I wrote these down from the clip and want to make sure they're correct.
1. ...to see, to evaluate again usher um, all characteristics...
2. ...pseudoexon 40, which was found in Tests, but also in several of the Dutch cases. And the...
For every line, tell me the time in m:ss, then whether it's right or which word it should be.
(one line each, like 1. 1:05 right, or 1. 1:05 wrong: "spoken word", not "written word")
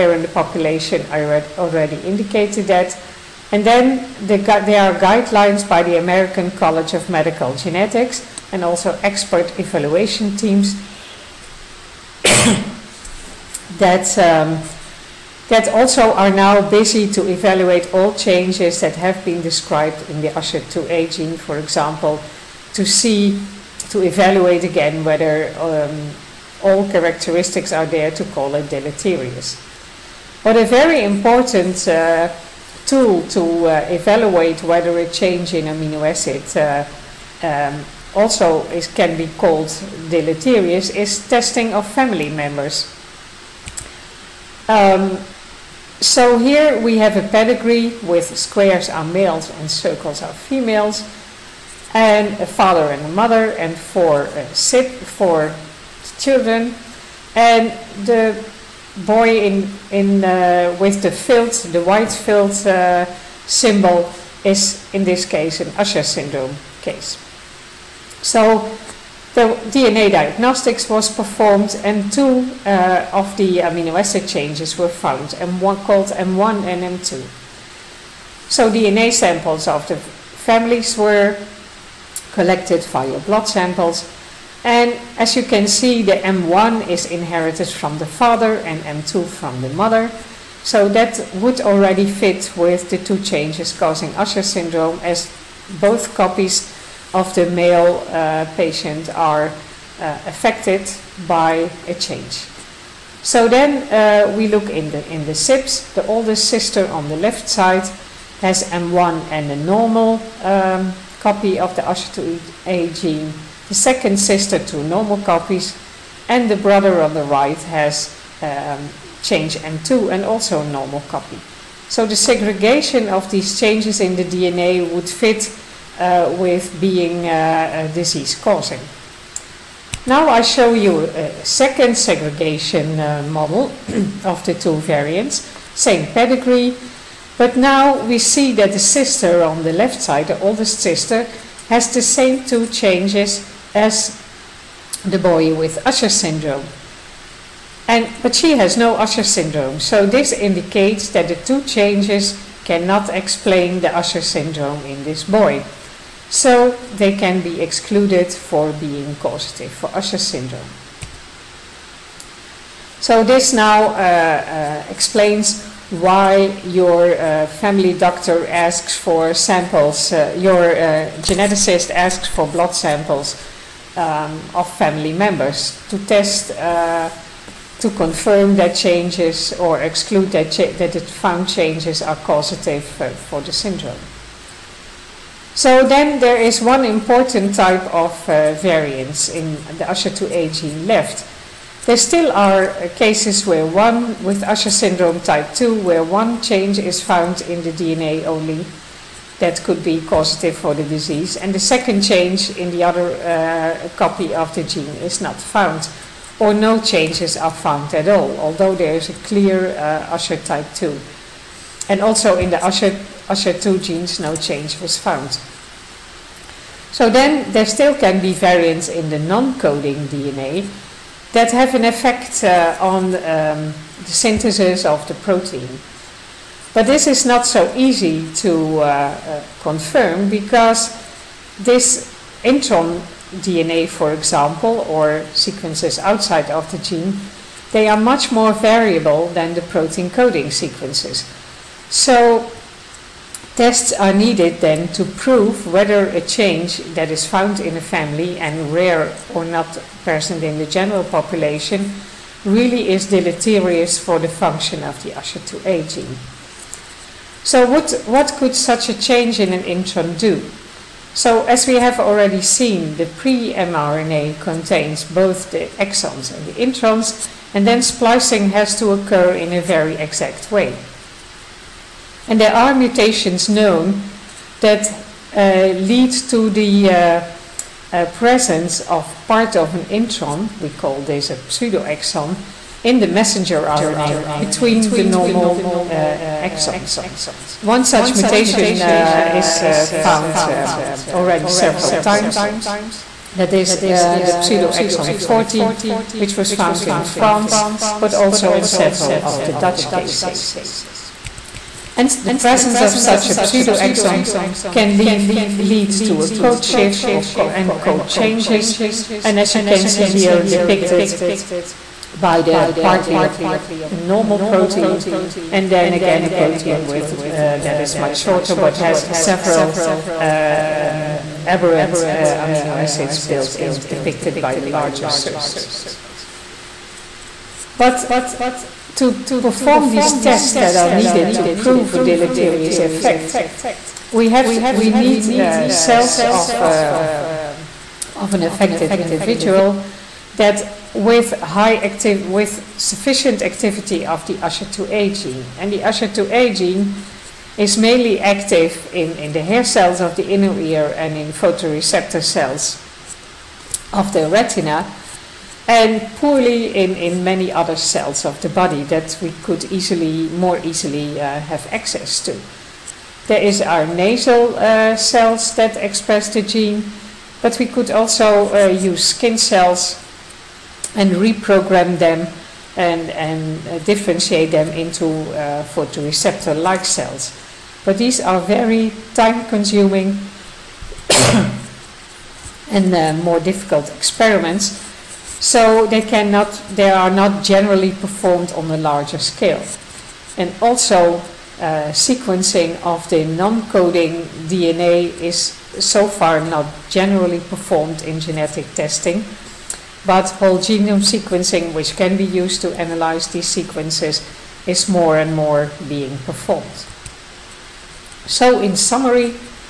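1. 0:22 wrong: "whether", not "usher"
2. 4:54 wrong: "France", not "Tests".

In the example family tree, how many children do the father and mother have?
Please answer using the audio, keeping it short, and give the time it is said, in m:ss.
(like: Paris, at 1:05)
4, at 0:54.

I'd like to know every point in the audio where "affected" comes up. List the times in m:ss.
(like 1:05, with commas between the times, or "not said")
1:40, 5:38.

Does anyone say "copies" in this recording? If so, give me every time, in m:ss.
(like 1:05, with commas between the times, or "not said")
1:36, 1:55.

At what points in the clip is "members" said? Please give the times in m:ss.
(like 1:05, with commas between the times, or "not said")
0:42, 2:55.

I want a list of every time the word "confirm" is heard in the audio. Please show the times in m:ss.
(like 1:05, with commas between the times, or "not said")
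2:57, 3:49.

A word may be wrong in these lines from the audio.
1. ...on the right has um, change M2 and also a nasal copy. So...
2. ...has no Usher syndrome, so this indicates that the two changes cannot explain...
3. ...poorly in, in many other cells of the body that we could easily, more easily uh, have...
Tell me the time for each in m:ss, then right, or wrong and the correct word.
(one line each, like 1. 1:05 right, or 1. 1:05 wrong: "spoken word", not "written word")
1. 1:57 wrong: "normal", not "nasal"
2. 2:28 right
3. 5:56 right.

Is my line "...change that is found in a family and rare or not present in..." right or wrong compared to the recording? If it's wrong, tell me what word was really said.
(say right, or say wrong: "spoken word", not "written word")
right.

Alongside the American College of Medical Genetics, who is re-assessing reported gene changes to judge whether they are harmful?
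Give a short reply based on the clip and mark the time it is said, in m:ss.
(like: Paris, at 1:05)
expert evaluation teams, at 0:09.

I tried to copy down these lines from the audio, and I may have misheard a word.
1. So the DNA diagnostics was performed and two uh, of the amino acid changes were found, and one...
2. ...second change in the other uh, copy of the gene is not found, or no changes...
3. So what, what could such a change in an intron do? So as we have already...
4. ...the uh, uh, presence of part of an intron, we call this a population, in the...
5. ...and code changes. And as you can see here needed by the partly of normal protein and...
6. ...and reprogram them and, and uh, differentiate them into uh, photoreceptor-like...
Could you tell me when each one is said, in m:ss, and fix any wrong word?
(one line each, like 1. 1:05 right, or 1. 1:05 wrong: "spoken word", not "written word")
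1. 1:08 right
2. 3:21 right
3. 4:17 right
4. 4:36 wrong: "pseudoexon", not "population"
5. 5:07 wrong: "depicted", not "needed"
6. 6:10 right.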